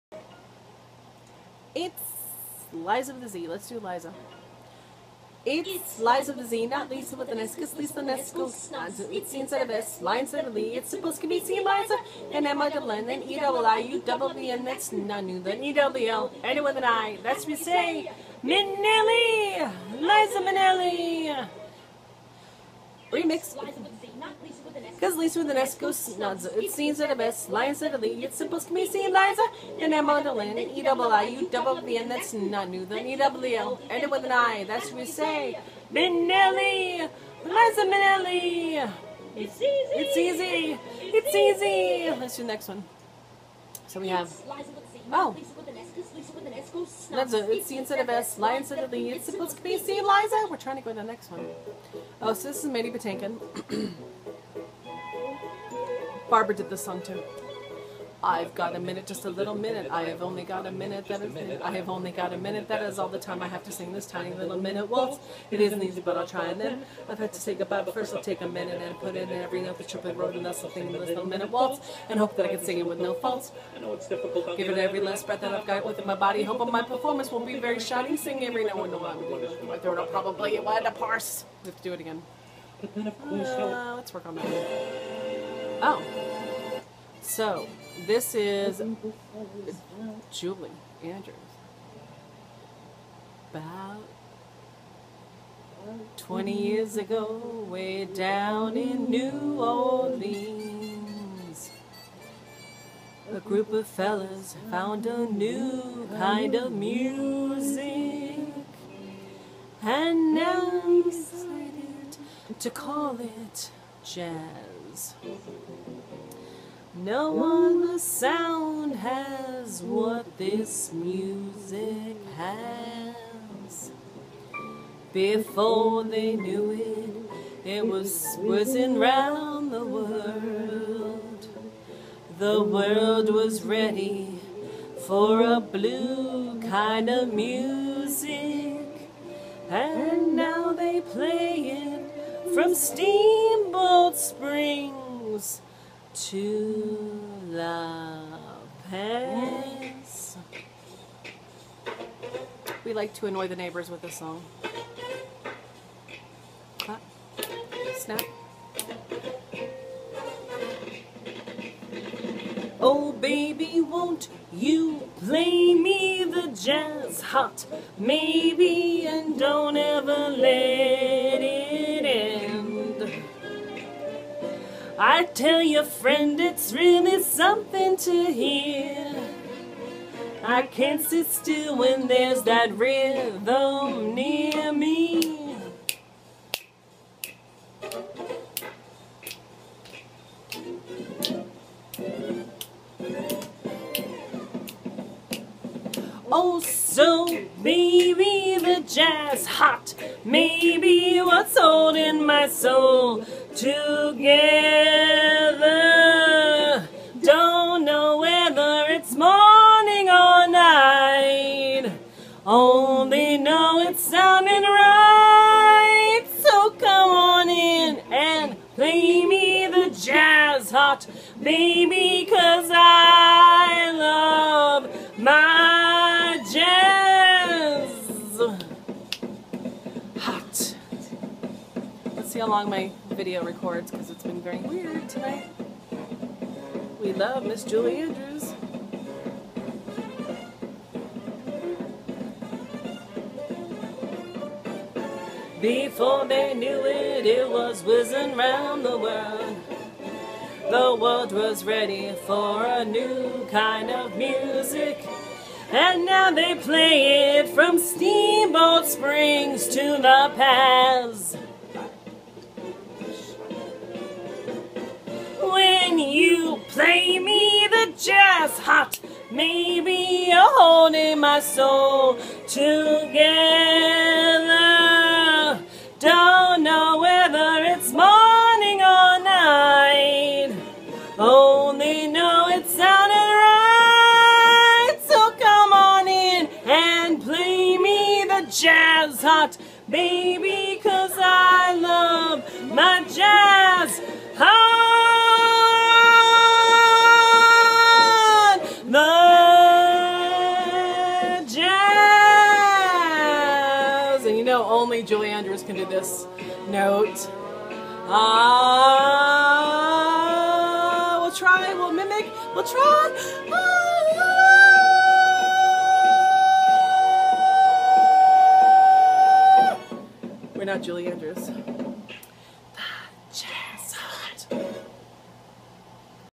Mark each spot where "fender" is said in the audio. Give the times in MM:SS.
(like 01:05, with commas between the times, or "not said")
not said.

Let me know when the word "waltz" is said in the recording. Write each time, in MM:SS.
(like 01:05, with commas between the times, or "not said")
01:04, 01:11.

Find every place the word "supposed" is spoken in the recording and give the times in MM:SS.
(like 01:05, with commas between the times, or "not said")
00:10, 00:28, 00:49.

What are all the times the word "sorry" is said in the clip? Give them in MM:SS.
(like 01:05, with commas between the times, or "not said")
not said.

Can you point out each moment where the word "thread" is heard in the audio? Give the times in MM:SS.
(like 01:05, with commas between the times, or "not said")
not said.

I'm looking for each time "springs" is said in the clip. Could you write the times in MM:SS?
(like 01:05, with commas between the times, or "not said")
02:24, 04:18.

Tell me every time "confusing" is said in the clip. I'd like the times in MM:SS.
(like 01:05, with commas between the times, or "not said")
not said.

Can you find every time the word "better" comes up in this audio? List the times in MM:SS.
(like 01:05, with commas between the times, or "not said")
not said.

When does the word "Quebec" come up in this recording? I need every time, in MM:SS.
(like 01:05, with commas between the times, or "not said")
not said.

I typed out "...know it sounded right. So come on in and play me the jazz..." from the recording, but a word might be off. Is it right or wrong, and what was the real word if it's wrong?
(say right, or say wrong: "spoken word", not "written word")
right.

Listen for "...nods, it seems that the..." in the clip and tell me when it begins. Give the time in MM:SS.
00:26.